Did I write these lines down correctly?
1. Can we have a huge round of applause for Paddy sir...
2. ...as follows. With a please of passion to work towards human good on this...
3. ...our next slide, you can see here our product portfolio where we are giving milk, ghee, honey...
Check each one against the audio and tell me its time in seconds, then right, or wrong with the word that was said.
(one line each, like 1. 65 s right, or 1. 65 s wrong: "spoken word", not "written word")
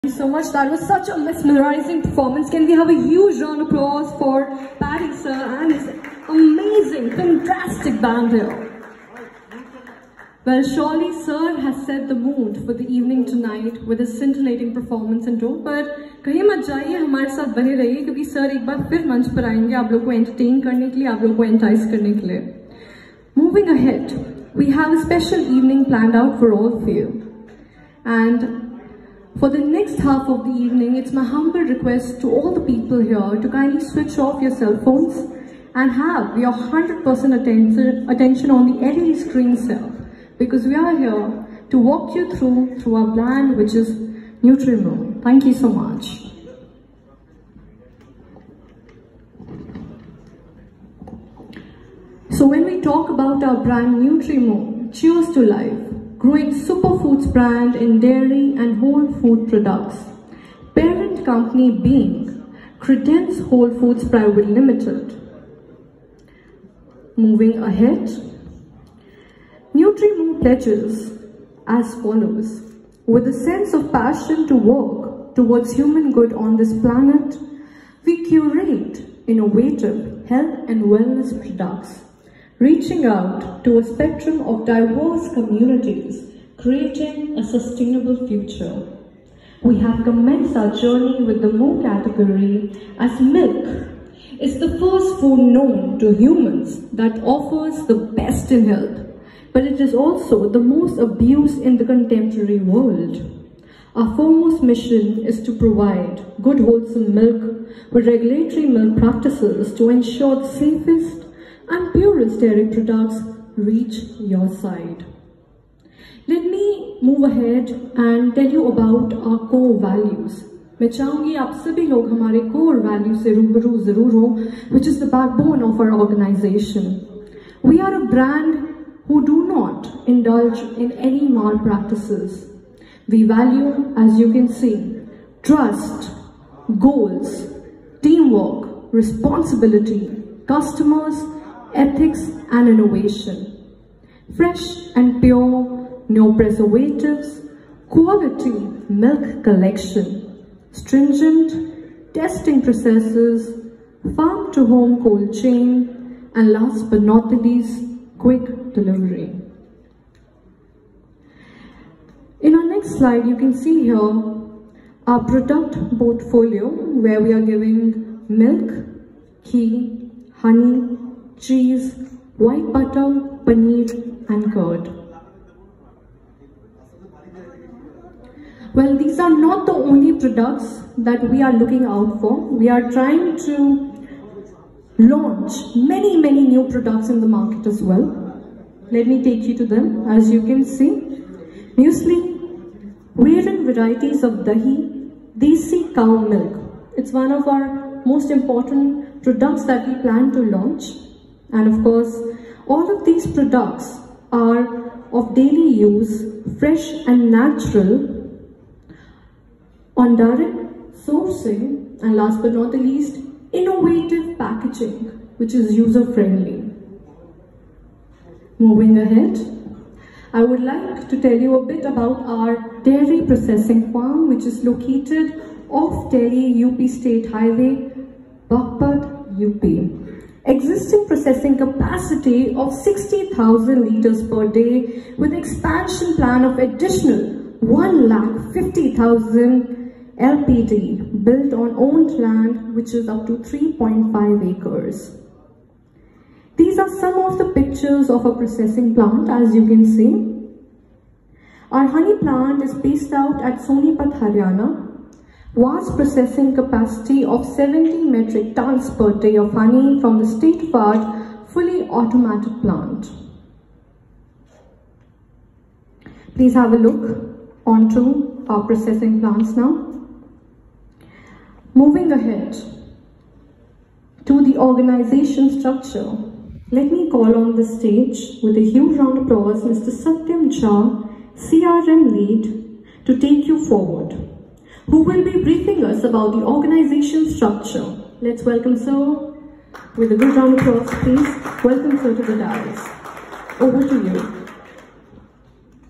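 1. 2 s right
2. 71 s wrong: "sense", not "please"
3. 162 s right.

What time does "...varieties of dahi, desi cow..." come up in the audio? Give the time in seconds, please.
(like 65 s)
193 s.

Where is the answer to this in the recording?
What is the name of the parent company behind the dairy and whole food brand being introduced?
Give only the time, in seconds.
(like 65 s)
62 s.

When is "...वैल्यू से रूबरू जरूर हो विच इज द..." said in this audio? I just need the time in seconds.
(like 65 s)
122 s.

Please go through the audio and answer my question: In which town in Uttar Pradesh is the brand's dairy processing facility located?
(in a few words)
Bagpat.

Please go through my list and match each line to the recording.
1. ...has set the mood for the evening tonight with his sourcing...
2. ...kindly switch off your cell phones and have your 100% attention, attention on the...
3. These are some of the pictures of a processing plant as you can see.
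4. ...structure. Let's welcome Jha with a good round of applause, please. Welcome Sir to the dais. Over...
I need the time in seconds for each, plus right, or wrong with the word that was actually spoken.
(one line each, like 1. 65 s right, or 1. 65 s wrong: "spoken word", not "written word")
1. 11 s wrong: "scintillating", not "sourcing"
2. 33 s right
3. 246 s right
4. 287 s wrong: "Sir", not "Jha".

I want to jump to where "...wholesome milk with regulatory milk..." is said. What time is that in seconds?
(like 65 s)
106 s.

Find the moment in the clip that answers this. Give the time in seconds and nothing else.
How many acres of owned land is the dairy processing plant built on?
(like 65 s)
243 s.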